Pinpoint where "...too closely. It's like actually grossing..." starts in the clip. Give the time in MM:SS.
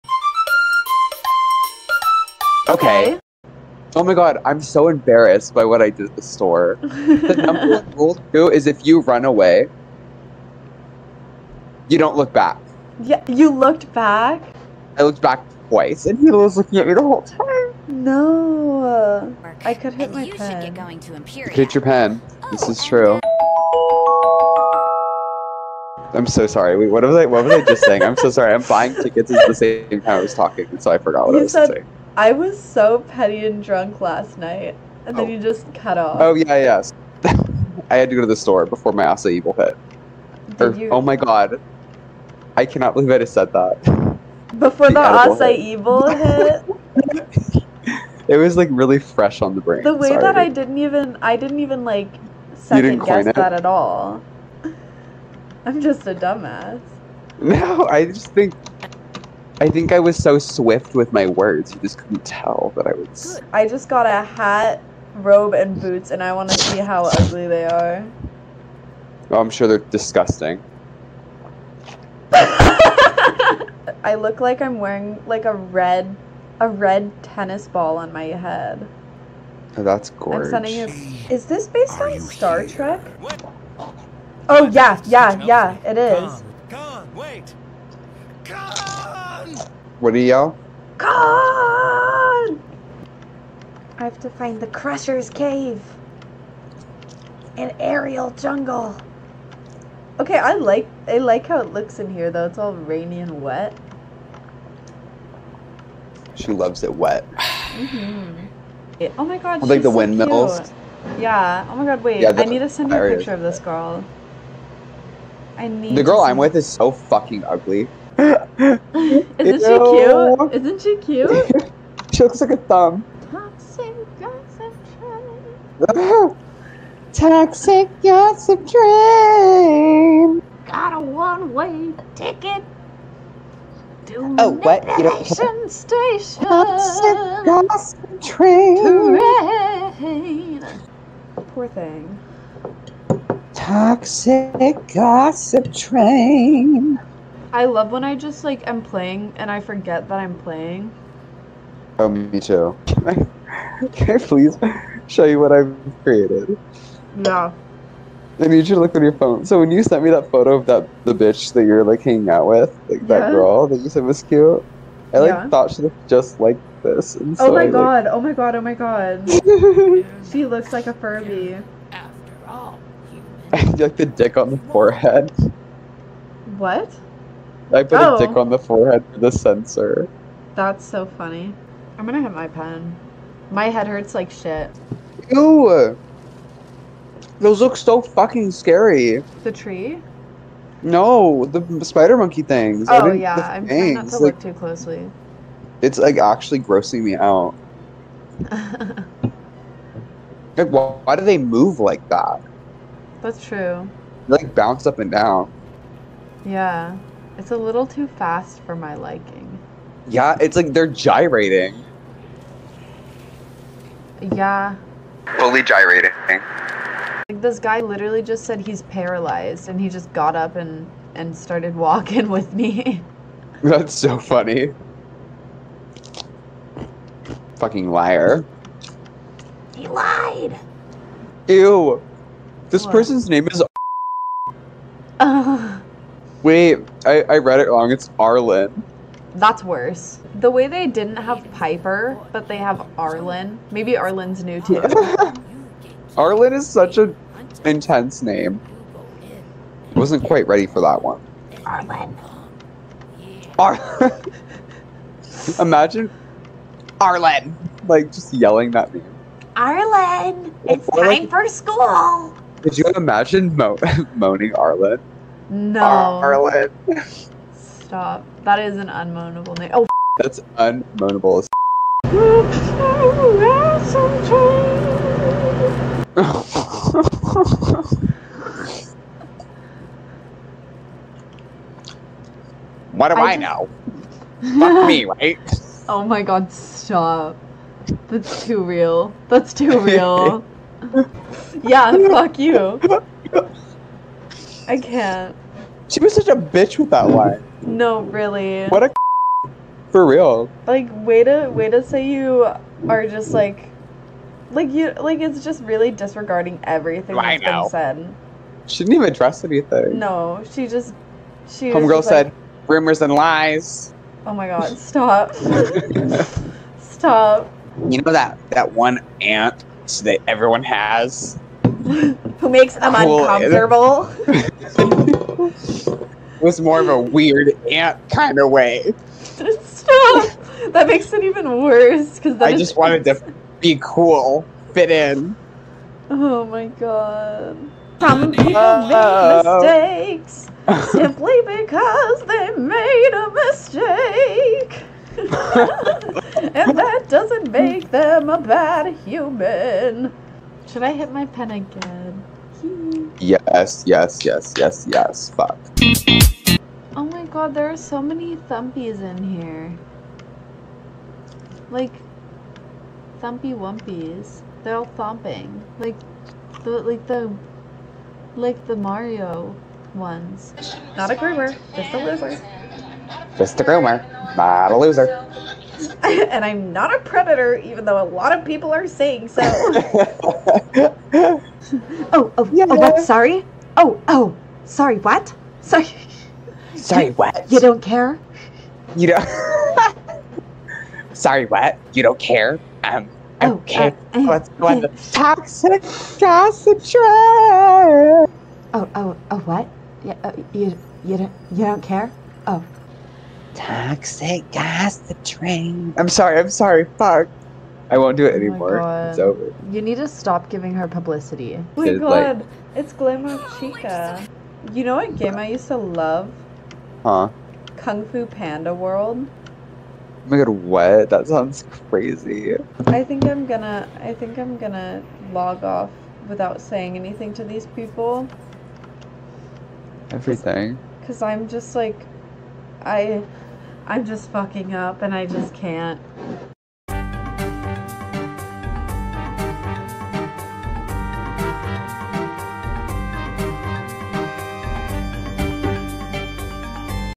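03:14.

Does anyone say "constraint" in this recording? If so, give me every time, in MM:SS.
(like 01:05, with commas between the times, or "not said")
not said.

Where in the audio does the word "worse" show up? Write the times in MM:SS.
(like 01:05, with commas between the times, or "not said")
03:59, 05:31.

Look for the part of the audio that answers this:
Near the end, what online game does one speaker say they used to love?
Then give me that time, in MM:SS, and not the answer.
06:57.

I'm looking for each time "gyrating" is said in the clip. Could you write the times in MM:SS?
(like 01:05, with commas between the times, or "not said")
03:30, 03:35.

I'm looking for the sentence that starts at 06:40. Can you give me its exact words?
Yeah, uh, you, you don't, you don't care?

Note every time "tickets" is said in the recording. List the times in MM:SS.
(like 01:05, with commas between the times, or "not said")
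00:28, 02:12.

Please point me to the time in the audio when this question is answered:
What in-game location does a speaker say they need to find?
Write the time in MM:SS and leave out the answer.
01:34.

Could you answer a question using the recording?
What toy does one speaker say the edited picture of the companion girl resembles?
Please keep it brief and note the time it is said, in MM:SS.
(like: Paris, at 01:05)
A Furby, at 02:50.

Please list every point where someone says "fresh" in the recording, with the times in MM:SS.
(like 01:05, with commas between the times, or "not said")
00:48.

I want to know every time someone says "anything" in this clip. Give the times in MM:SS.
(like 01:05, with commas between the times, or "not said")
05:09, 07:06.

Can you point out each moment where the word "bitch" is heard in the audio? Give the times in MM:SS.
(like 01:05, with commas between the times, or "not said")
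02:41, 04:56.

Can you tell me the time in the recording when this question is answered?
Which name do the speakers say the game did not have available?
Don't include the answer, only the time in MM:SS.
04:01.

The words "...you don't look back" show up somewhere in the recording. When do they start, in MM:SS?
00:11.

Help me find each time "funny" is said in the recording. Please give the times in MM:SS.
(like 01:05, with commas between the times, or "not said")
03:01, 03:44.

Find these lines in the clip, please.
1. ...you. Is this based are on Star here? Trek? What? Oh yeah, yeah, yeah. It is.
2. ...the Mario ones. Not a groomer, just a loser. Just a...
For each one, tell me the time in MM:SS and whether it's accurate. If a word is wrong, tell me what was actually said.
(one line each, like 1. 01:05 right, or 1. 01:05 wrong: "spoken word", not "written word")
1. 01:20 right
2. 06:08 right.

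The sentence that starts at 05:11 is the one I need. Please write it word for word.
Homegirl said like, rumors and lies.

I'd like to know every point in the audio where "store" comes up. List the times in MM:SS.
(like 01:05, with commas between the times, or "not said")
00:06, 00:38.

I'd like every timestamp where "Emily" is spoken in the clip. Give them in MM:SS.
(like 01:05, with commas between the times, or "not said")
not said.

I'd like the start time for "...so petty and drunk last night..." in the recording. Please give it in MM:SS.
00:32.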